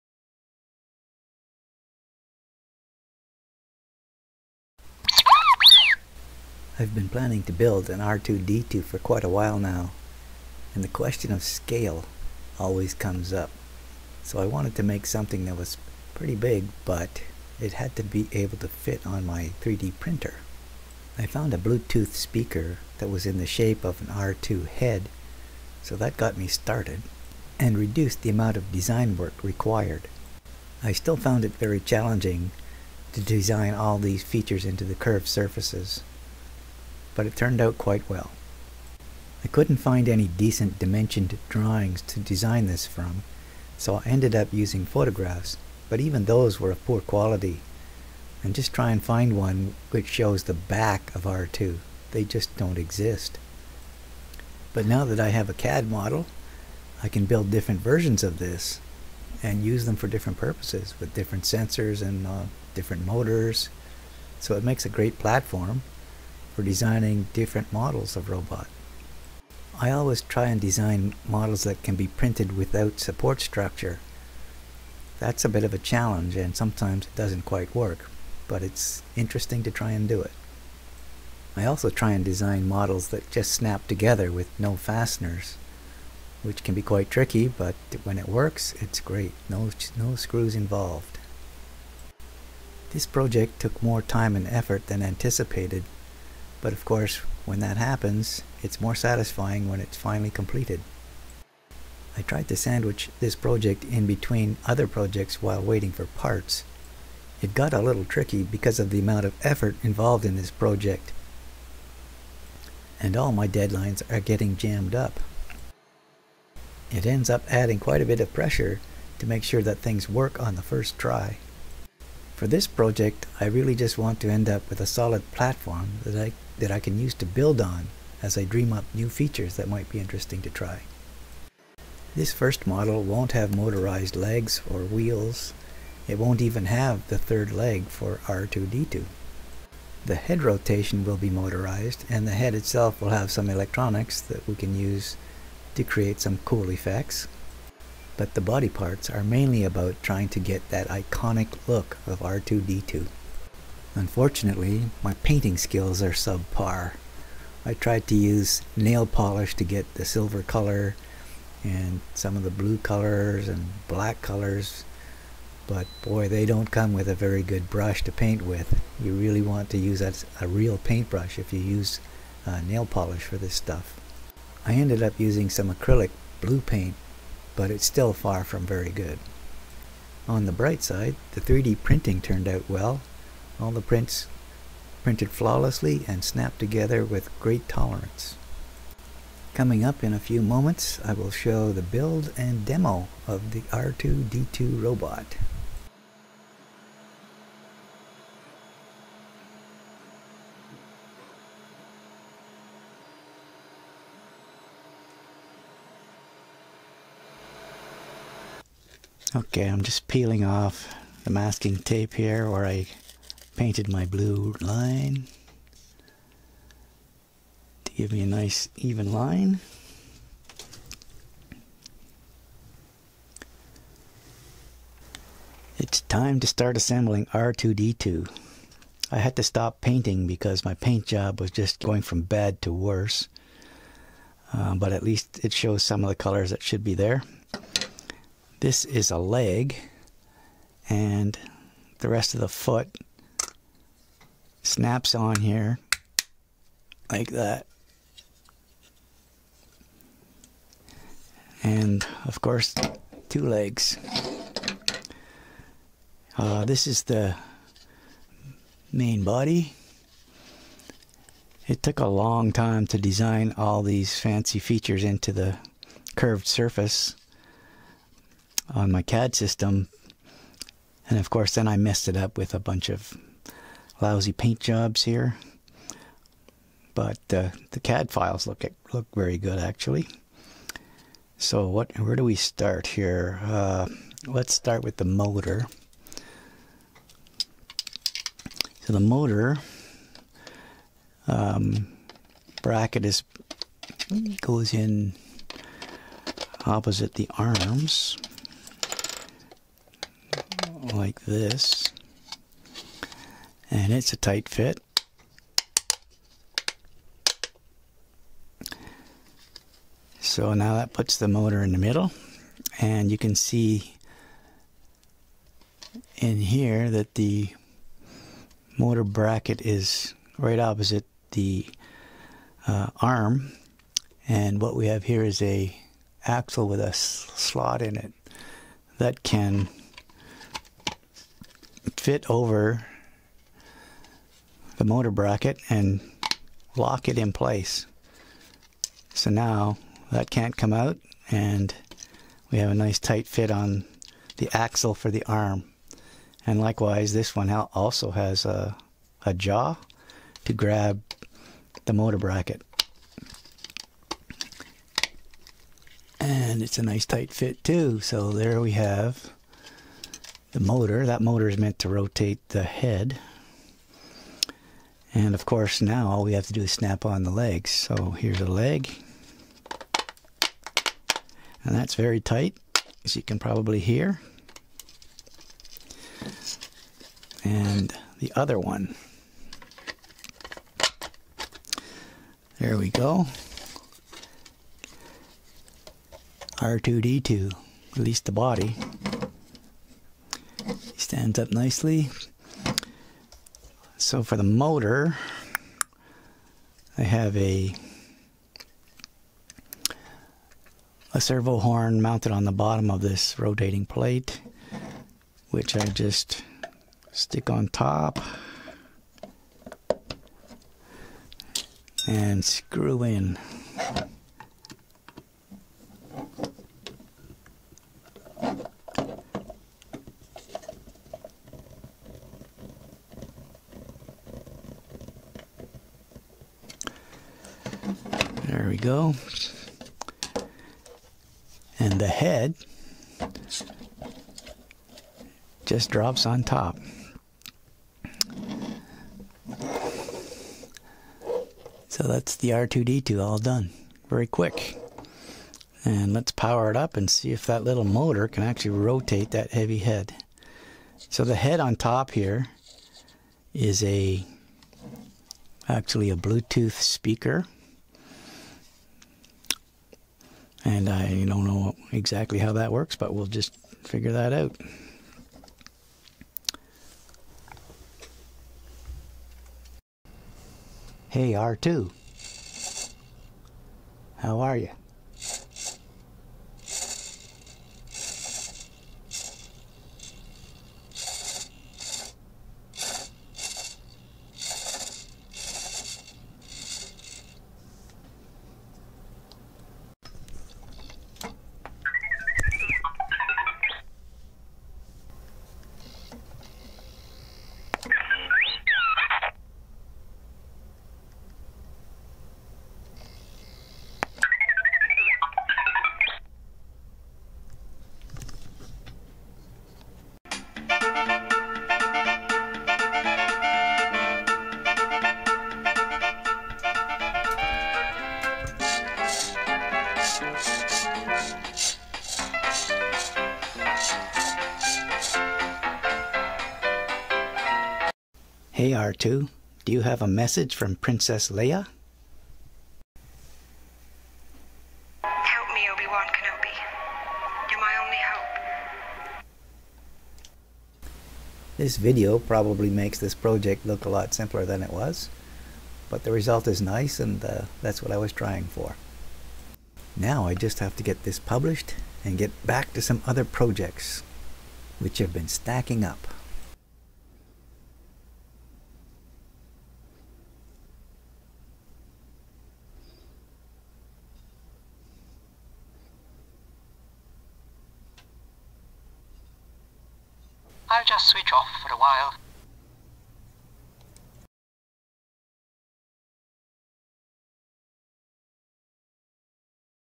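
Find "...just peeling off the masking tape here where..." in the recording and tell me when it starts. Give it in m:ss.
3:29.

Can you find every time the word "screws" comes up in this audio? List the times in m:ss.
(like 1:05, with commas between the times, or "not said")
1:30, 6:52.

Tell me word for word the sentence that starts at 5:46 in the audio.
And likewise, this one also has a, a jaw to grab the motor bracket.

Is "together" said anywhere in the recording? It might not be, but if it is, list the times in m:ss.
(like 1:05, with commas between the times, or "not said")
1:23, 3:06.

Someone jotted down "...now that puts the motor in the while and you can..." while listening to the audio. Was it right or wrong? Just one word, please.
wrong.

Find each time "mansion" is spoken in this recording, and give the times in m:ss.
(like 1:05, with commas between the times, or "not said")
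not said.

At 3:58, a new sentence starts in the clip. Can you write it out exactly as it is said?
This is a leg and the rest of the foot snaps on here like that.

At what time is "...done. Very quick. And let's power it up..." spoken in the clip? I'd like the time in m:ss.
7:23.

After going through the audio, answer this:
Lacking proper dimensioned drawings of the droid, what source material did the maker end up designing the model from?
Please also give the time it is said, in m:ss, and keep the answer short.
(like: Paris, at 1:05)
photographs, at 0:44.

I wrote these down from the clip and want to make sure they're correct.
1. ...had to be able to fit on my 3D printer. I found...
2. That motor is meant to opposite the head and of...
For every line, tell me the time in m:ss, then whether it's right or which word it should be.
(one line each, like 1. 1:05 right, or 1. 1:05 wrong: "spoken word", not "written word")
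1. 0:17 right
2. 6:01 wrong: "rotate", not "opposite".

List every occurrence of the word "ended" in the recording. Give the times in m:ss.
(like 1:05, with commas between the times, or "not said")
0:44, 2:54.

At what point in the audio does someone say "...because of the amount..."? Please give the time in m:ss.
1:48.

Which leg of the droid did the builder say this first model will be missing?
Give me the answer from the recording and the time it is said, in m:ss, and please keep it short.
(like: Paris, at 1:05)
the third leg, at 2:17.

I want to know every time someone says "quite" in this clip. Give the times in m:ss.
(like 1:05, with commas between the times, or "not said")
0:08, 0:37, 1:17, 1:26, 1:57.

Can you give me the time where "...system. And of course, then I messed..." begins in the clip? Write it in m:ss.
4:29.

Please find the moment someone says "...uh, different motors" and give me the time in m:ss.
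1:02.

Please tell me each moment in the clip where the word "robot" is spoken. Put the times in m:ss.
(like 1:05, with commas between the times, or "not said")
1:08, 3:14.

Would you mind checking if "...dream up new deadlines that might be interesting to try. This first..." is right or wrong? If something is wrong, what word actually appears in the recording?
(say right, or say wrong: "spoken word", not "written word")
wrong: "features", not "deadlines".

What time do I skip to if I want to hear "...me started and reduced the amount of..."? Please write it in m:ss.
0:26.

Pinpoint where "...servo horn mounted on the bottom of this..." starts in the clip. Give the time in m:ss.
6:41.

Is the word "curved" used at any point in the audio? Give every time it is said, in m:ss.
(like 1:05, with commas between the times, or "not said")
0:34, 4:26.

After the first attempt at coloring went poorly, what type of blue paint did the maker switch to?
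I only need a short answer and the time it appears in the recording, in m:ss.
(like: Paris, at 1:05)
acrylic, at 2:55.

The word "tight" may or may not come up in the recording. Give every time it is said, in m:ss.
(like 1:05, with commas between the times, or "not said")
5:04, 5:42, 5:57, 6:12.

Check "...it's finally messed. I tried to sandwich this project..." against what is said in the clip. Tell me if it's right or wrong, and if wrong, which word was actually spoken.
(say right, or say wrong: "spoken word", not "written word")
wrong: "completed", not "messed".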